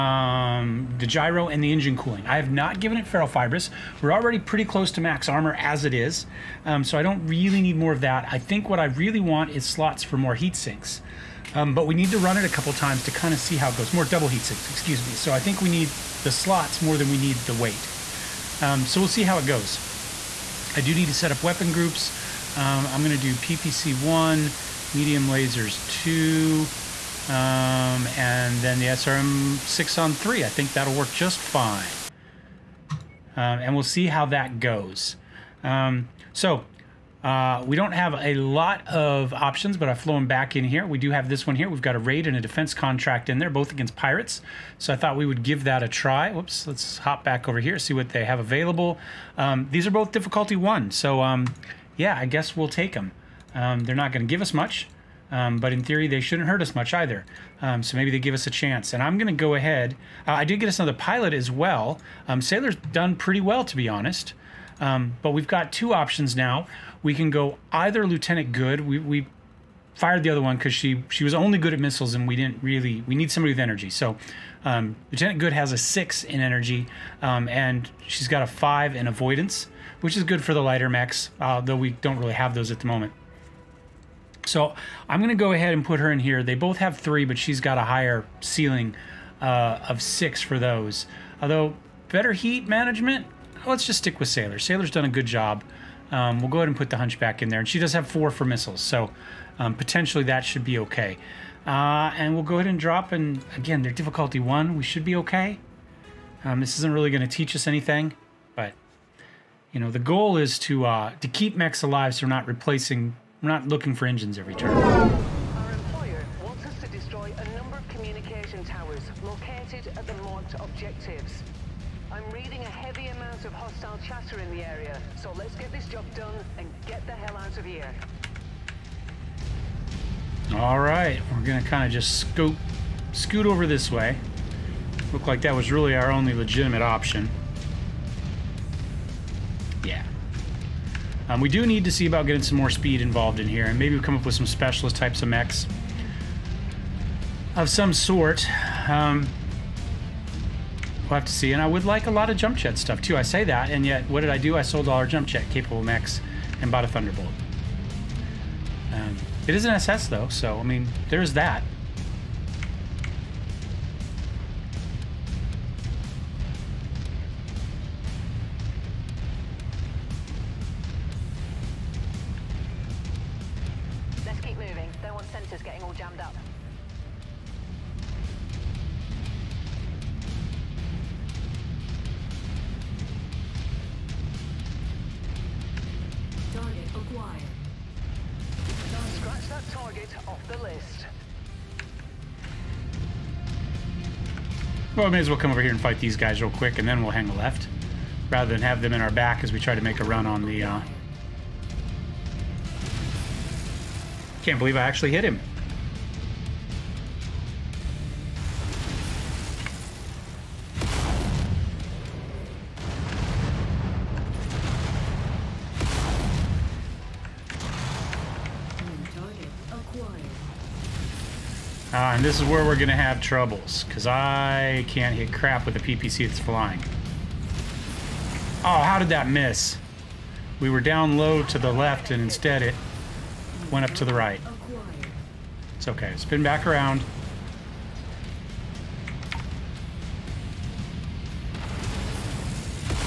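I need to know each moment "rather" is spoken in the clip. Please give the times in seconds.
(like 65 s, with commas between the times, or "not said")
198 s.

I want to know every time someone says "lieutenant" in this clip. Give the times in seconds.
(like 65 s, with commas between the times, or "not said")
68 s, 75 s.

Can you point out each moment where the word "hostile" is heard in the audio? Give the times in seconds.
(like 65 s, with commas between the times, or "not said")
123 s.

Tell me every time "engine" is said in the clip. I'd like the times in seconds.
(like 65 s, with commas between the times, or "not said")
1 s, 114 s.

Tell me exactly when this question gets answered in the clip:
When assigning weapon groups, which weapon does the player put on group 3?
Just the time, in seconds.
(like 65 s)
28 s.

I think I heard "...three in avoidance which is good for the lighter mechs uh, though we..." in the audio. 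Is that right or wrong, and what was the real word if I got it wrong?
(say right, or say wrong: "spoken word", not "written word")
wrong: "five", not "three".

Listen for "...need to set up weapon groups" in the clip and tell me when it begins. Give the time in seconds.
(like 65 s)
20 s.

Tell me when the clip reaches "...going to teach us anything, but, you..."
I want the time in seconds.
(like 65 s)
107 s.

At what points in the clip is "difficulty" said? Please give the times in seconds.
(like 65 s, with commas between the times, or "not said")
50 s, 103 s.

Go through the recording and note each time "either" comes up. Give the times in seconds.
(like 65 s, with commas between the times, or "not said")
56 s, 67 s.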